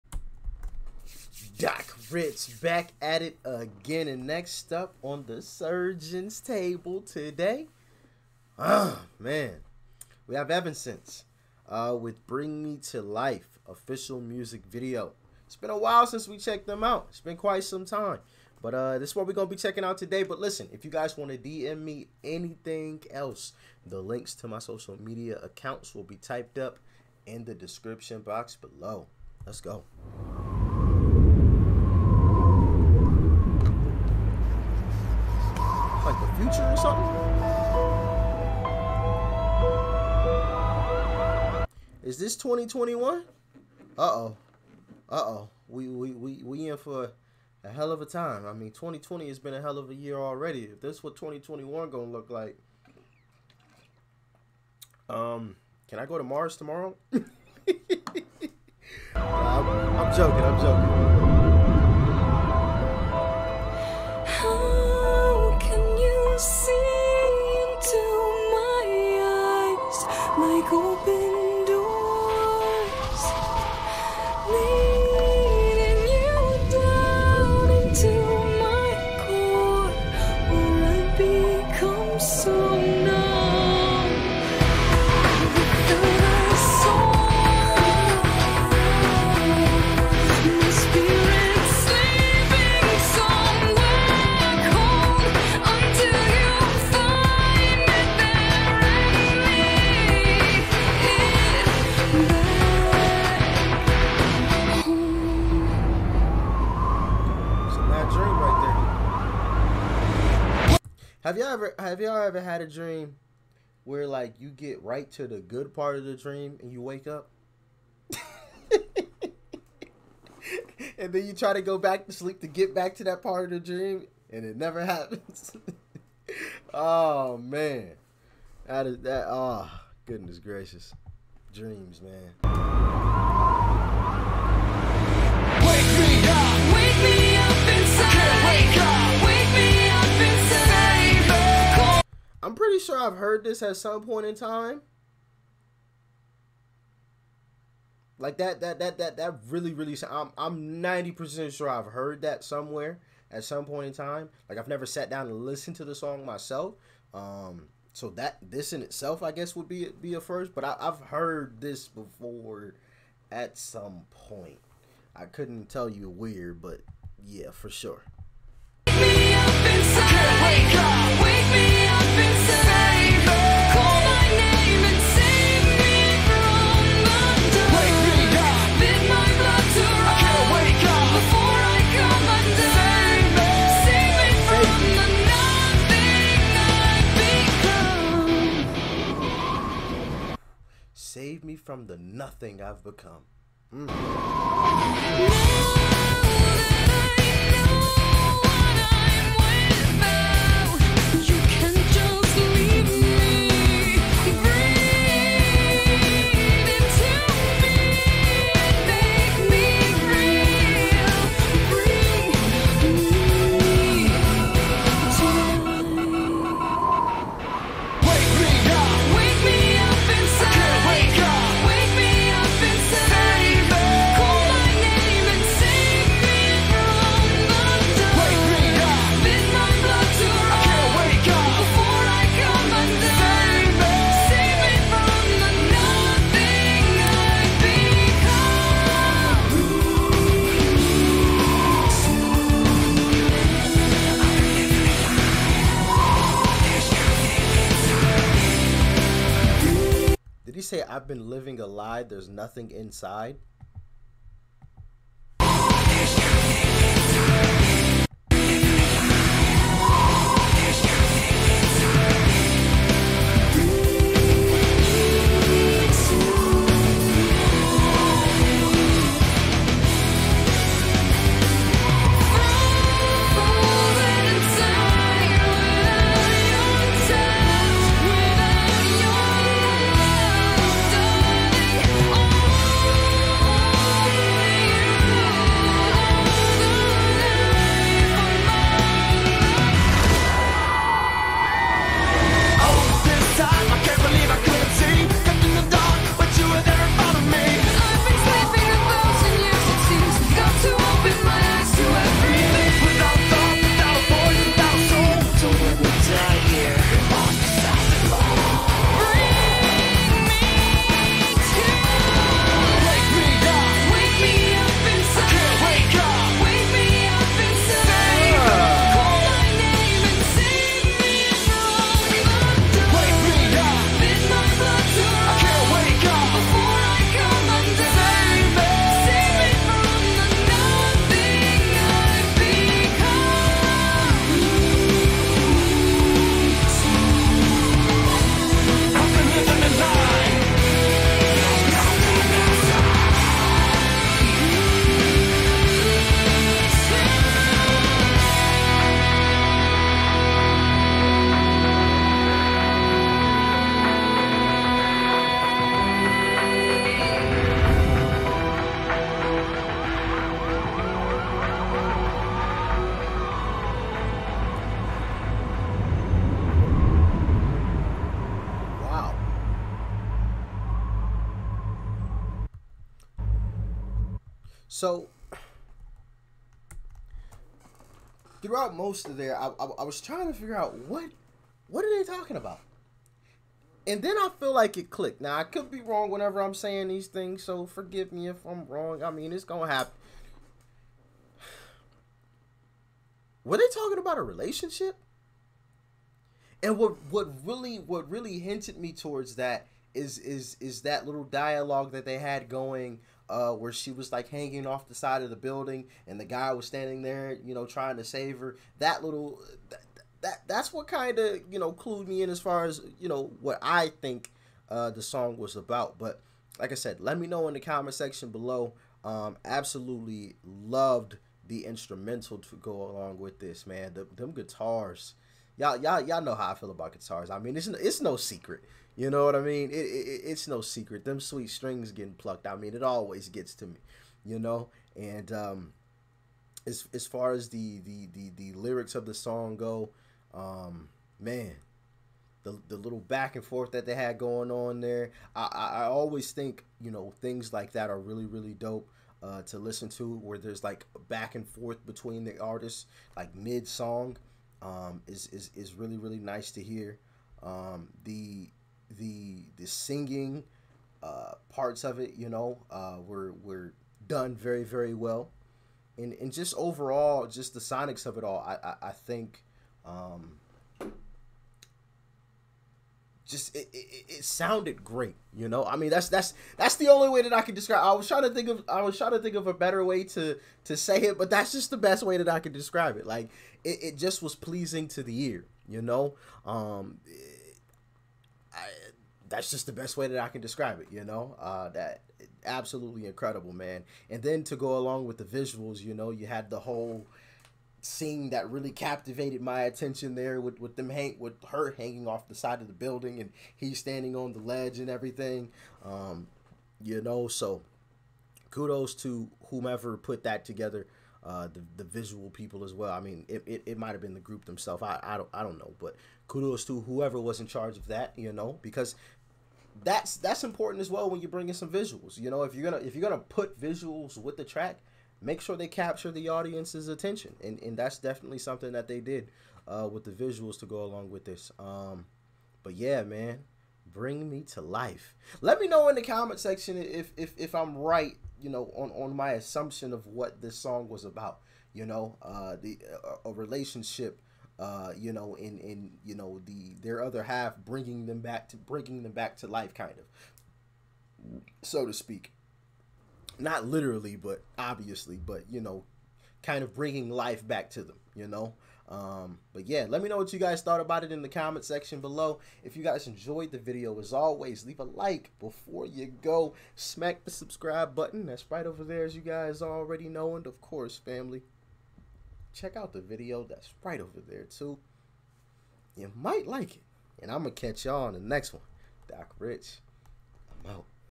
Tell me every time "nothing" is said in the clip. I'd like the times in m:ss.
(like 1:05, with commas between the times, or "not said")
3:11, 4:12.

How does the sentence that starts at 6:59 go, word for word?
Um, absolutely loved the instrumental to go along with this, man.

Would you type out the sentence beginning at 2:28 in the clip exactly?
Like that, that, that, that, that really, really.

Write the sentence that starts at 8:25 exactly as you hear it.
Um, you know, so kudos to whomever put that together.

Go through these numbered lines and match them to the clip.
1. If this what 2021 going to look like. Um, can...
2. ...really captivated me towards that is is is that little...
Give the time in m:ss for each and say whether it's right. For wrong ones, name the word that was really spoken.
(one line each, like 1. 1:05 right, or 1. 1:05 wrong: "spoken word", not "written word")
1. 0:50 right
2. 6:38 wrong: "hinted", not "captivated".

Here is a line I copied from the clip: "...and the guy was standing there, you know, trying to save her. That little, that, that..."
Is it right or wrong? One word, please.
right.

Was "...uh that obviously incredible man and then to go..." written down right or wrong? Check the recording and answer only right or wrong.
wrong.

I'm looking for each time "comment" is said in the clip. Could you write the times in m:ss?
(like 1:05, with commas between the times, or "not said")
6:57, 8:56, 9:21.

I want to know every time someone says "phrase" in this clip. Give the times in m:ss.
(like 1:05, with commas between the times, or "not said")
not said.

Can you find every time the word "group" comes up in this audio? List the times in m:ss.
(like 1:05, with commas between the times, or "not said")
8:34.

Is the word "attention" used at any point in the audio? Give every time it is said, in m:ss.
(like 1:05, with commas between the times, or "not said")
8:19, 8:46.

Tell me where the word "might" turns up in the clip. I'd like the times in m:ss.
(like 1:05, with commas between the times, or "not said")
8:33, 9:36.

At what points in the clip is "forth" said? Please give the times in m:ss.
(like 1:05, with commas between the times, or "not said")
7:23, 7:31.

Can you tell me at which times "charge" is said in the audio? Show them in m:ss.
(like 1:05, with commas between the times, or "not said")
8:37.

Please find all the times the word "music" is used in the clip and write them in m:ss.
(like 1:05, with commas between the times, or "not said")
0:14.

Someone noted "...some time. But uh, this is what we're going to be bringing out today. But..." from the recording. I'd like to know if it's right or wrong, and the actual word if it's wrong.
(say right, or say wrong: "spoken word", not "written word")
wrong: "checking", not "bringing".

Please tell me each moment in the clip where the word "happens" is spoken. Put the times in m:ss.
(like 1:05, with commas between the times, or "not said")
2:04, 6:29.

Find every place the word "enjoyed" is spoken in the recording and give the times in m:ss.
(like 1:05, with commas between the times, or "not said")
9:23.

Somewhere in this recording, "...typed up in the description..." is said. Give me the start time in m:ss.
0:26.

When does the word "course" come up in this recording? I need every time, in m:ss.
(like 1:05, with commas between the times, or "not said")
9:30.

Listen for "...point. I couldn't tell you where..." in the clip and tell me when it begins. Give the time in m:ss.
2:44.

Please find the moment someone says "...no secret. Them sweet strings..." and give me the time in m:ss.
7:10.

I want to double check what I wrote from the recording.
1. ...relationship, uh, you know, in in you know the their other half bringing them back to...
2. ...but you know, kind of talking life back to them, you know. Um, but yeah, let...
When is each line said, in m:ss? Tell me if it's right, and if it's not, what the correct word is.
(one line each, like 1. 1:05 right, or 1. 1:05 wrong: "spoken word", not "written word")
1. 9:03 right
2. 9:15 wrong: "bringing", not "talking".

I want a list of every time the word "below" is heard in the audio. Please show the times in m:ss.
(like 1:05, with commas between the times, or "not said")
0:28, 6:58, 9:22.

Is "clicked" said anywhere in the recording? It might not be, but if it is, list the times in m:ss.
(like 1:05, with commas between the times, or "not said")
6:24.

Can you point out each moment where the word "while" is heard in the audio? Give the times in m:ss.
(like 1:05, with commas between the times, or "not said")
0:15.